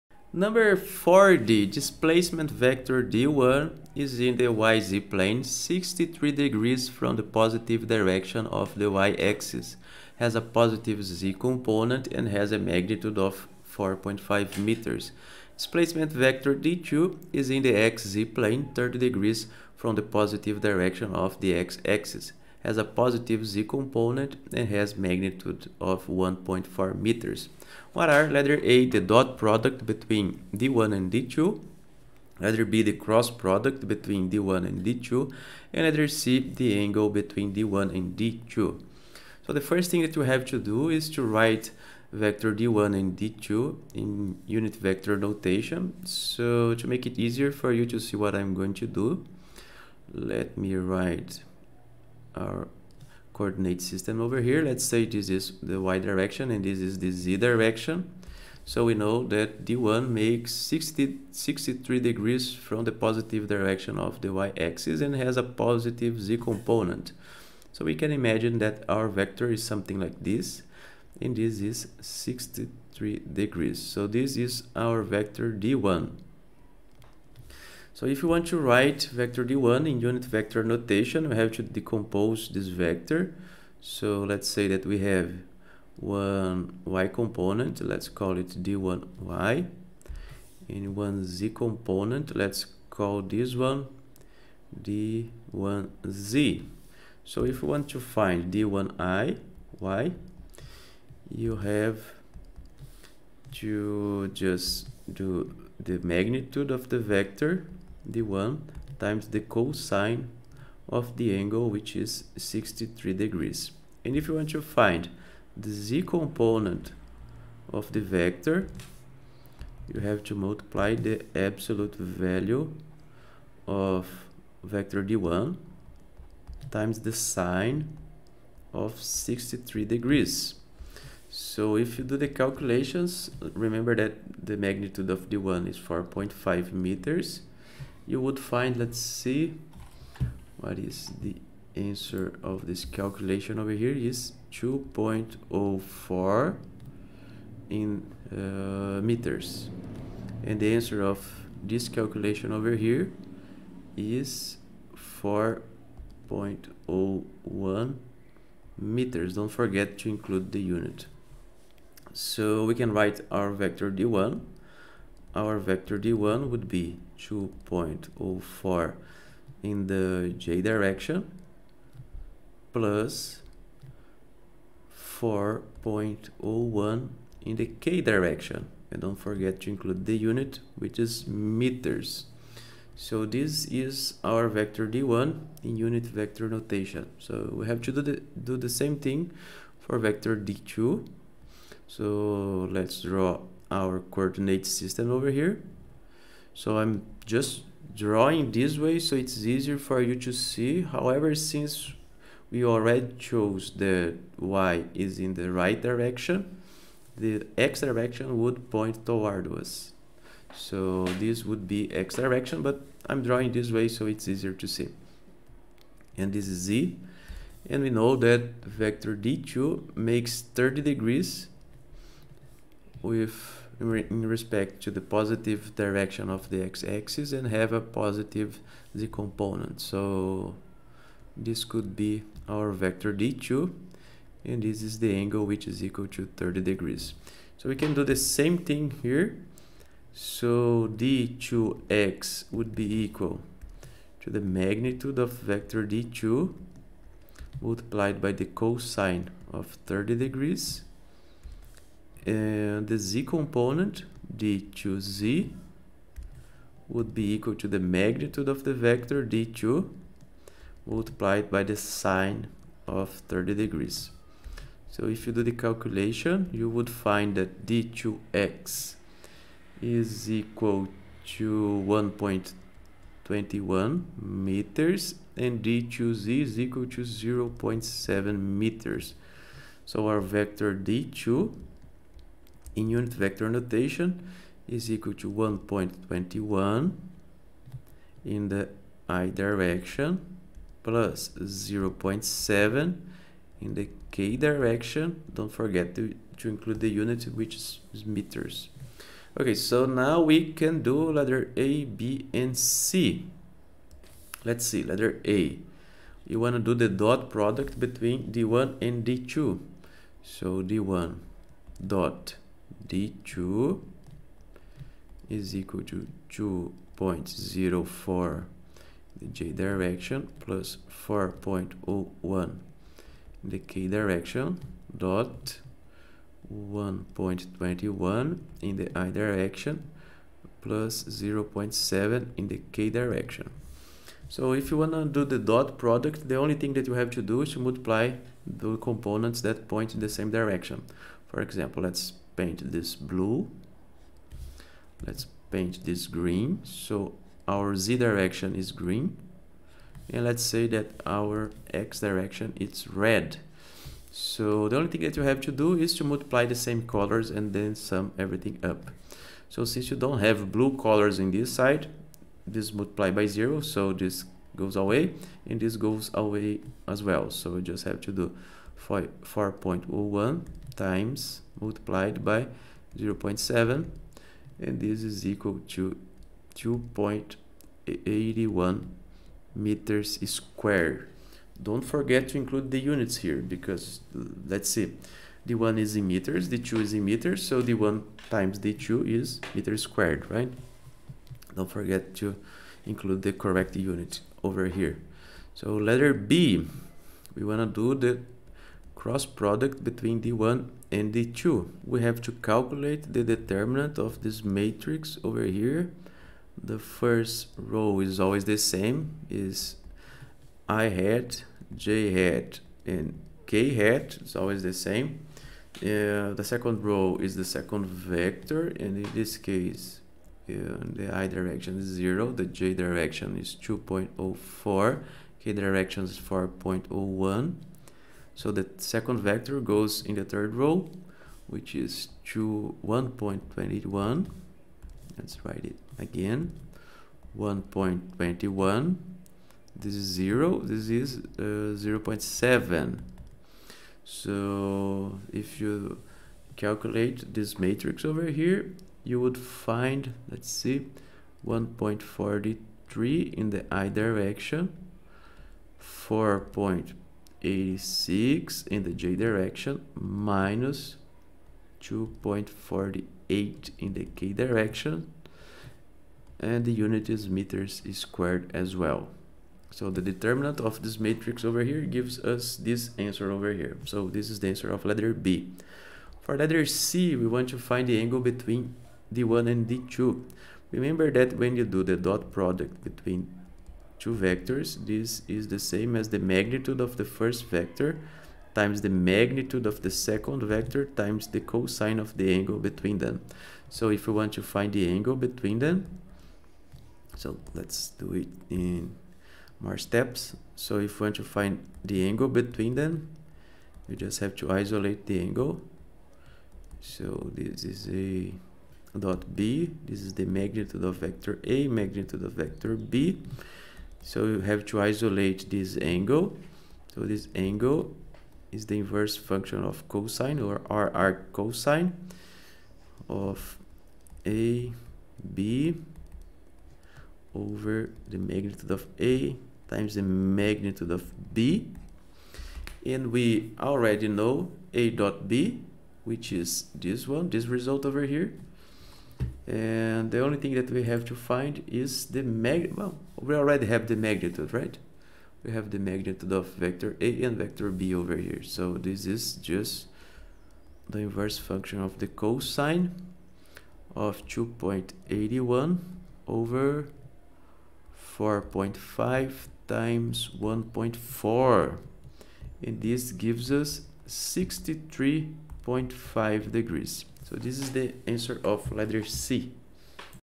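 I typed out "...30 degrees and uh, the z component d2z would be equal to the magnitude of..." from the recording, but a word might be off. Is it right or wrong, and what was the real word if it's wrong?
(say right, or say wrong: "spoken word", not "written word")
right.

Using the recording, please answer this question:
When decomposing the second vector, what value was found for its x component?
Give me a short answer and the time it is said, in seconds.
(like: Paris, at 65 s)
1.21 meters, at 271 s.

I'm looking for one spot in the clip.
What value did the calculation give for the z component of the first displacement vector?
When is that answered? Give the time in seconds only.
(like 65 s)
155 s.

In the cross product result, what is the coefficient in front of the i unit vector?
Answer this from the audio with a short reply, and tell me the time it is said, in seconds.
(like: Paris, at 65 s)
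1.43, at 451 s.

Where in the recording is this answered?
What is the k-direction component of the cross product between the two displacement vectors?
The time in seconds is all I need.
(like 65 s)
459 s.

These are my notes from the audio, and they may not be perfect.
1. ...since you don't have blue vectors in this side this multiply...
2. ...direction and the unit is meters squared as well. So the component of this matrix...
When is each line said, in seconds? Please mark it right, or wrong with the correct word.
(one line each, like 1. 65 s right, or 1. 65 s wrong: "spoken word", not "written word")
1. 359 s wrong: "colors", not "vectors"
2. 464 s wrong: "determinant", not "component".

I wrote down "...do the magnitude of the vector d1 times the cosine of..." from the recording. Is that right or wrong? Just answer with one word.
right.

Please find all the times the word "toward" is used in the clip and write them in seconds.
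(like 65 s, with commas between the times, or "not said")
209 s.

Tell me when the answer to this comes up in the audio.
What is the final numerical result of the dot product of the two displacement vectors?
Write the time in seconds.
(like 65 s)
376 s.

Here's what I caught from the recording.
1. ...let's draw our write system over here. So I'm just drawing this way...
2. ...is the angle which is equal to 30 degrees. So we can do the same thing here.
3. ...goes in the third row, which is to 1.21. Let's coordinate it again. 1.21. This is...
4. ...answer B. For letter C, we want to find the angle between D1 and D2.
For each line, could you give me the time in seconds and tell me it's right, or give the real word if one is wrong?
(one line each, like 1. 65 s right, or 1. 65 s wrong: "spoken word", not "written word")
1. 192 s wrong: "coordinate", not "write"
2. 234 s right
3. 429 s wrong: "write", not "coordinate"
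4. 474 s wrong: "letter", not "answer".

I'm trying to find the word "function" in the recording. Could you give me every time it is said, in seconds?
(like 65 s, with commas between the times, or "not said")
519 s, 551 s.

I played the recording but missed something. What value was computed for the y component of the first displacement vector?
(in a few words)
2.04 meters.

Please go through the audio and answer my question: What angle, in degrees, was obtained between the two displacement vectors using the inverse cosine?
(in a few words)
63.5 degrees.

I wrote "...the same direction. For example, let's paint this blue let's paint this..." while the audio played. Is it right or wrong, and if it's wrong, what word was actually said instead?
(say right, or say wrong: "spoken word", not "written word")
right.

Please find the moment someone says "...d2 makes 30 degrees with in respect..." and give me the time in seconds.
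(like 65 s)
219 s.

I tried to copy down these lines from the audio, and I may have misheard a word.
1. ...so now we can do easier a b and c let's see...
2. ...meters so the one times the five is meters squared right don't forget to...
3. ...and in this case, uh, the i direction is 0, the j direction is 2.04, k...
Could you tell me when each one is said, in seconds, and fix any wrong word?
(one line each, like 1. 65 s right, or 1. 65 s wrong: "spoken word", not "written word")
1. 299 s wrong: "letter", not "easier"
2. 387 s wrong: "two", not "five"
3. 418 s right.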